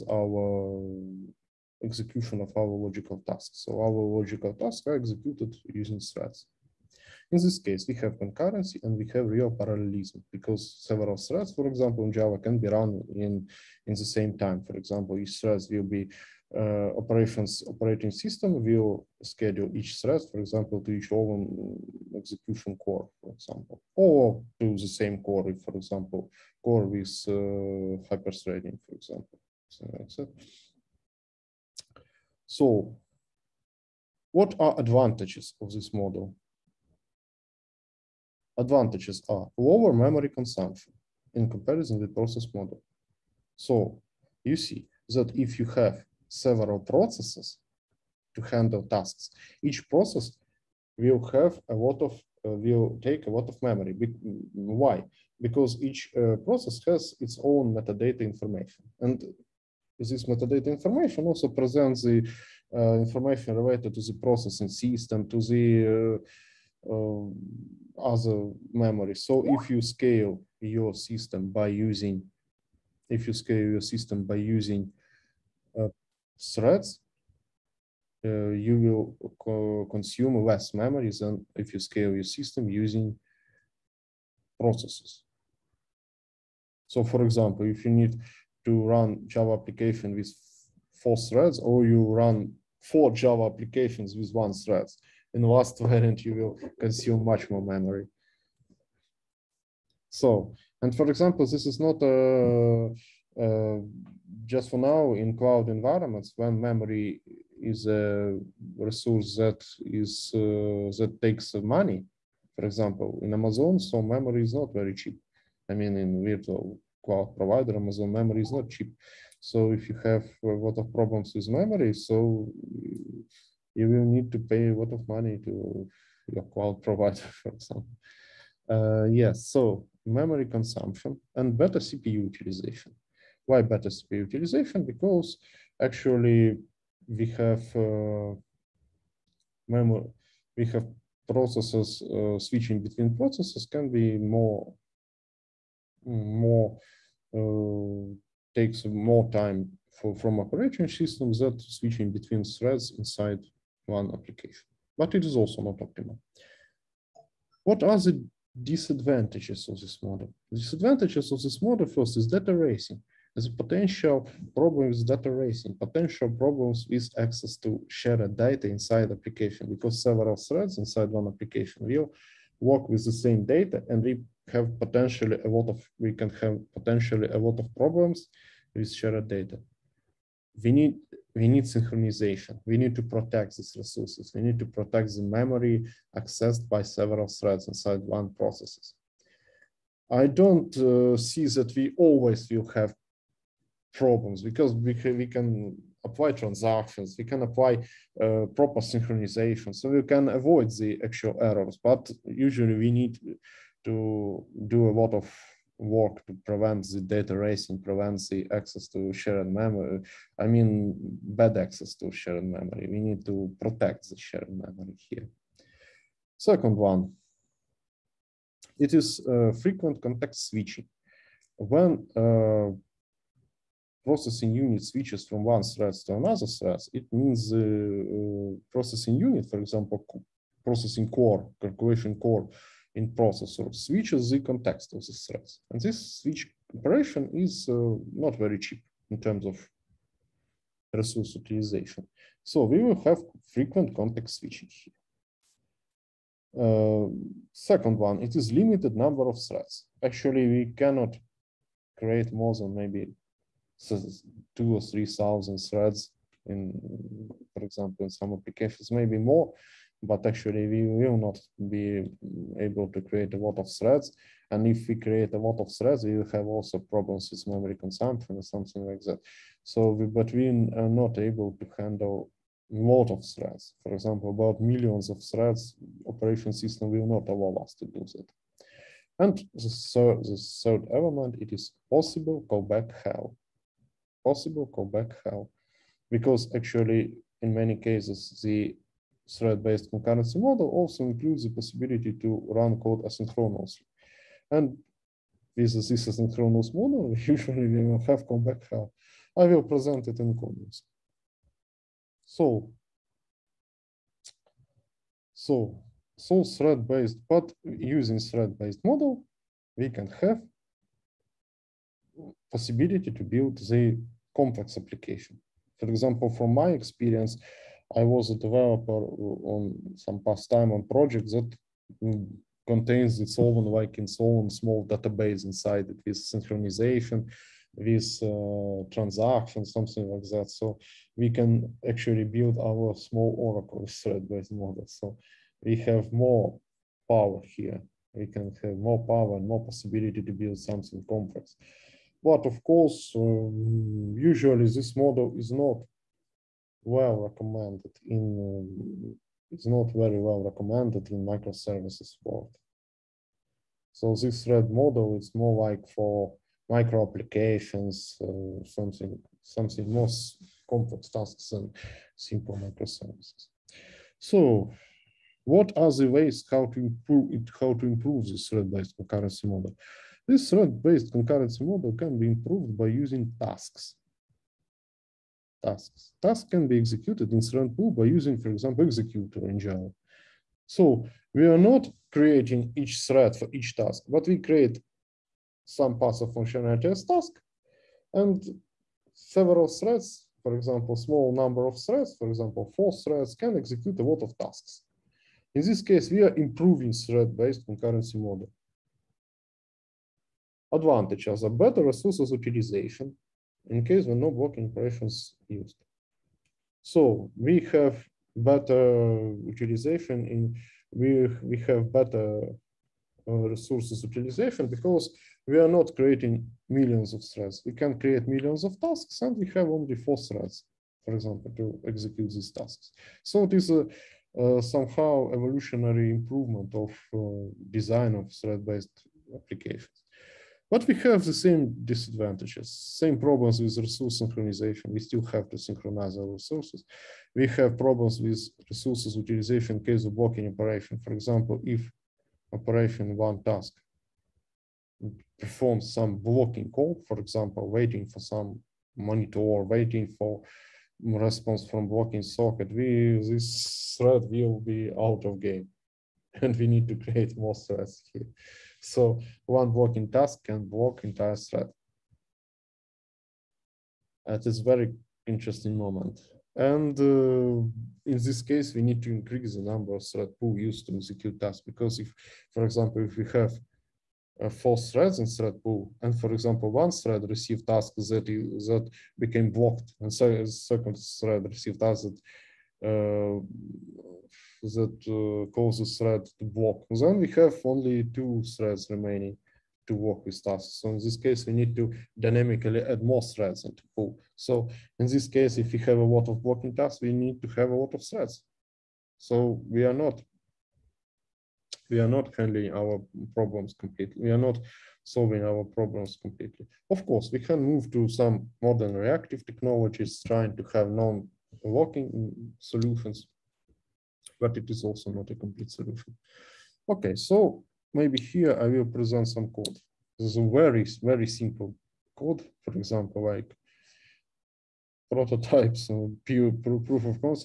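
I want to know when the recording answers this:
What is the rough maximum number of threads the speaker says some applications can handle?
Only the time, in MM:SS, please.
04:14.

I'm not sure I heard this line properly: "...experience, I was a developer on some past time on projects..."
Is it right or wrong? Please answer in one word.
right.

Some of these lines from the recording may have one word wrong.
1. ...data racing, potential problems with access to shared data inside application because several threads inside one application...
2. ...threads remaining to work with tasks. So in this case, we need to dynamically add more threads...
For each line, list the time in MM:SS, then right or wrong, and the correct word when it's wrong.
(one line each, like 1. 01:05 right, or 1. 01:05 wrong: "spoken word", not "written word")
1. 02:45 right
2. 08:08 right.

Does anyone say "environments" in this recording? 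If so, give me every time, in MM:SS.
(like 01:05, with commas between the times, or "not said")
01:45.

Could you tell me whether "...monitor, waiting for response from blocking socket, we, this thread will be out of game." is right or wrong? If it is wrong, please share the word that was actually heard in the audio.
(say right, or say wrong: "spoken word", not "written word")
right.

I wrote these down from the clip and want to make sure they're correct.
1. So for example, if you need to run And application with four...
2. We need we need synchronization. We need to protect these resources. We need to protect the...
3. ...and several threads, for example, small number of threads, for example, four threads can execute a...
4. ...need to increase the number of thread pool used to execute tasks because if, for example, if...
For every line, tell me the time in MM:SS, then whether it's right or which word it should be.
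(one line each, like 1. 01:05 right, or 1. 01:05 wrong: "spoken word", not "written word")
1. 01:26 wrong: "Java", not "And"
2. 03:00 right
3. 06:28 right
4. 07:48 right.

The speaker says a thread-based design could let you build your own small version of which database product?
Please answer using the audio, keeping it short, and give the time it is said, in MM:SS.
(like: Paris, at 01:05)
Oracle, at 05:33.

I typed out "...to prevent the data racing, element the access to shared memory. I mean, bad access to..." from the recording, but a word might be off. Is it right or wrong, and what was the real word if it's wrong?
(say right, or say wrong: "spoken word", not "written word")
wrong: "prevent", not "element".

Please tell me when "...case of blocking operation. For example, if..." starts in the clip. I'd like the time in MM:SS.
07:19.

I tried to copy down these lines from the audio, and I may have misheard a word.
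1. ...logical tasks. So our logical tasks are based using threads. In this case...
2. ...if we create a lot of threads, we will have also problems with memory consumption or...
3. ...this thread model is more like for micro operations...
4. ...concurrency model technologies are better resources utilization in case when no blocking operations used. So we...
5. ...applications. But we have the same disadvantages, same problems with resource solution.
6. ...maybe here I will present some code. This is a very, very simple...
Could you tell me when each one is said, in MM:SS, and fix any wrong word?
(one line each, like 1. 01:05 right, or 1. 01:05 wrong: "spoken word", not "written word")
1. 00:02 wrong: "executed", not "based"
2. 04:24 right
3. 05:54 wrong: "applications", not "operations"
4. 06:37 wrong: "advantages", not "technologies"
5. 07:09 wrong: "synchronization", not "solution"
6. 08:37 right.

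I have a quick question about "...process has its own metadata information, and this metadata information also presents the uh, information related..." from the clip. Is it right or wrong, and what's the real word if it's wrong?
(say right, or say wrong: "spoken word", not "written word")
right.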